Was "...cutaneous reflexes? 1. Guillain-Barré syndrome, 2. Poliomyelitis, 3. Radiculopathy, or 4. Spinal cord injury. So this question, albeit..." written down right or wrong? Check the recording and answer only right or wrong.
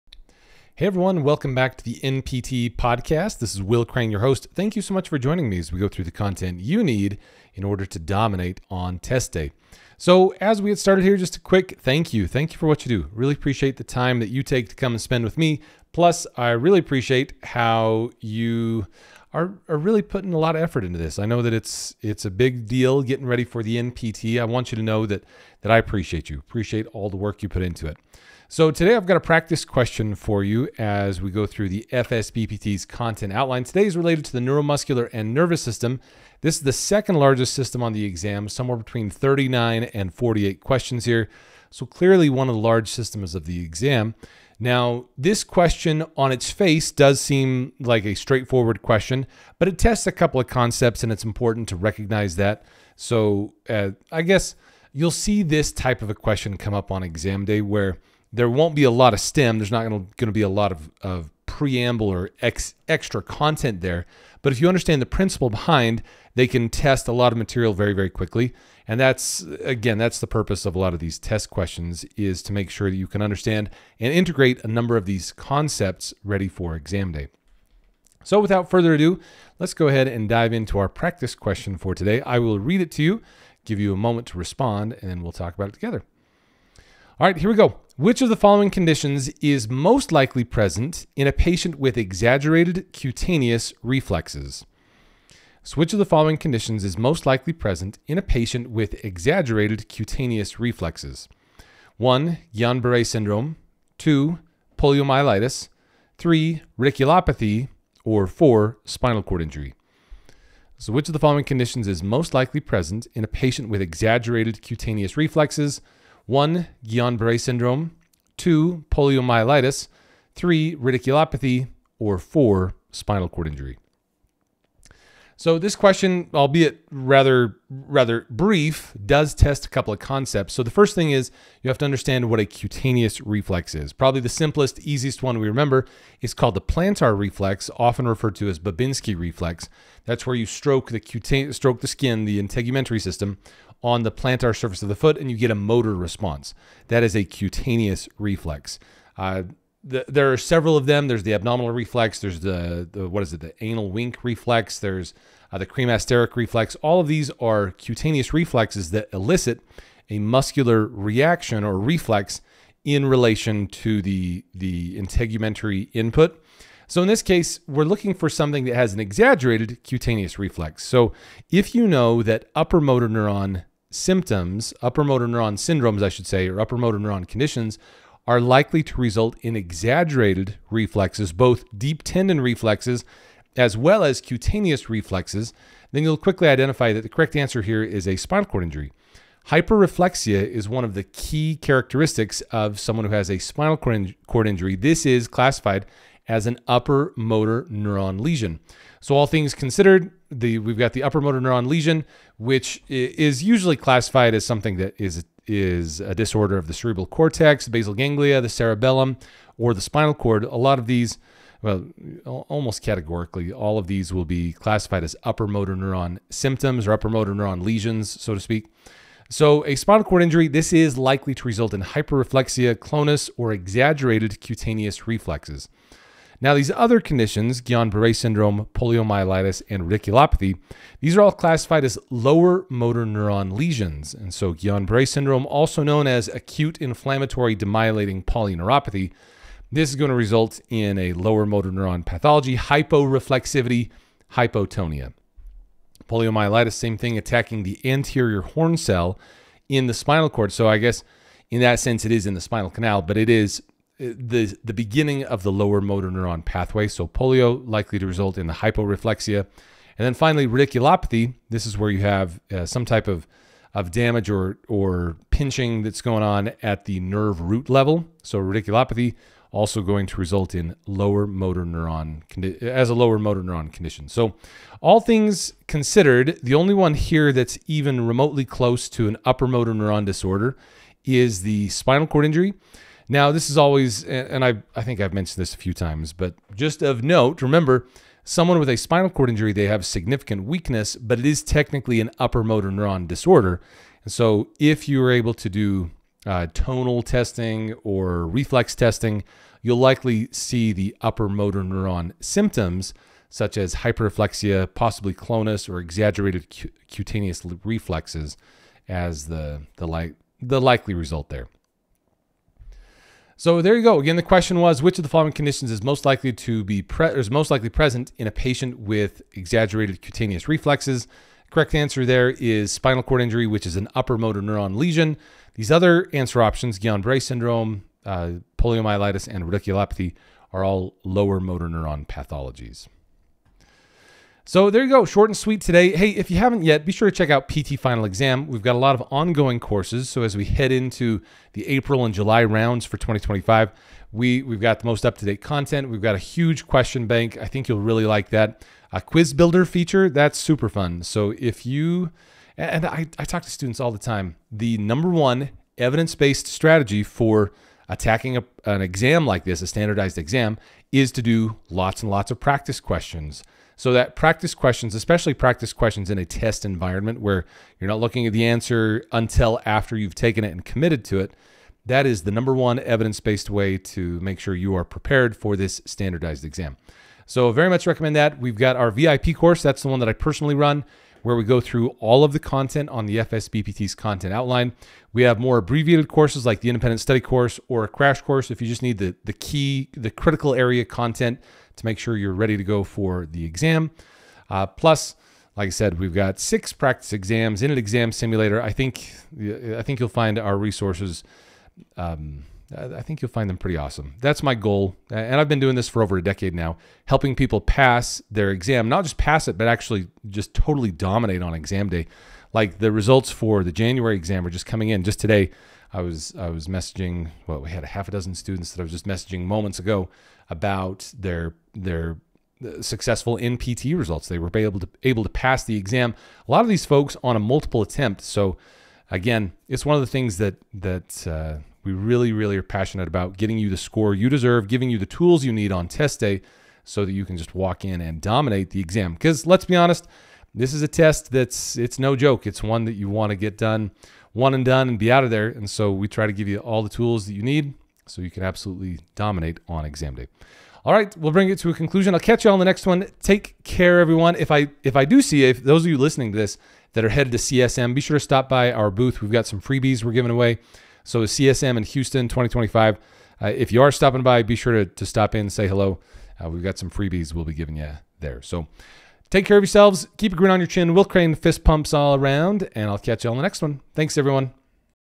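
right.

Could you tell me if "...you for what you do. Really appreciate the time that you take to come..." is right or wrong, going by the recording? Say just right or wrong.
right.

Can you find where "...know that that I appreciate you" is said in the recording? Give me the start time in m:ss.
0:24.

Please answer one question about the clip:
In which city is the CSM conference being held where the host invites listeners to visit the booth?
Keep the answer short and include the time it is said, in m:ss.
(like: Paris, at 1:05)
Houston, at 7:41.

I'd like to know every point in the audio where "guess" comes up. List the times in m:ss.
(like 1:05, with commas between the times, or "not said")
0:54, 4:10.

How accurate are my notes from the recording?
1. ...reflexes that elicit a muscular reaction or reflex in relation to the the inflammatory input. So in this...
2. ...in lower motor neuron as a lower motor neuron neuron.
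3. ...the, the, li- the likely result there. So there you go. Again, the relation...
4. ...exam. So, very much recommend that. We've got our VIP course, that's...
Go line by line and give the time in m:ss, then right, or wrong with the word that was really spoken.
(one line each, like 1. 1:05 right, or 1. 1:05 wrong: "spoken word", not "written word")
1. 2:38 wrong: "integumentary", not "inflammatory"
2. 4:30 wrong: "condition", not "neuron"
3. 5:09 wrong: "question", not "relation"
4. 6:16 right.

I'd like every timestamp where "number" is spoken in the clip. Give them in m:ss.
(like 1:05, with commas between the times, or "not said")
1:14, 5:54, 6:12.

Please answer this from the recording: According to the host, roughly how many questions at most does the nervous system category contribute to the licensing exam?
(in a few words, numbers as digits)
48.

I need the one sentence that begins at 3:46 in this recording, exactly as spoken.
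Now, these other conditions, Guillain-Barré syndrome, poliomyelitis, and radiculopathy, these are all classified as lower motor neuron lesions.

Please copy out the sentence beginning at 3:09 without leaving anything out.
Hyperreflexia is one of the key characteristics of someone who has a spinal cord injury.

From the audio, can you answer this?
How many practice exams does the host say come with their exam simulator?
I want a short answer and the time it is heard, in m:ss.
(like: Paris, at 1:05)
6, at 6:36.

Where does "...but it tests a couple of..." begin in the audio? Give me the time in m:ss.
0:49.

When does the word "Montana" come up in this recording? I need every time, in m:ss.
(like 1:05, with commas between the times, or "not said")
not said.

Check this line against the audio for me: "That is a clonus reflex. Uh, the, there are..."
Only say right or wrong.
wrong.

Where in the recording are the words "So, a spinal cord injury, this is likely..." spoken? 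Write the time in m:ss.
3:39.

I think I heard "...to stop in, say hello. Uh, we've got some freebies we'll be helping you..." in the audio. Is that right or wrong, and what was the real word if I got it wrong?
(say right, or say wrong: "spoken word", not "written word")
wrong: "giving", not "helping".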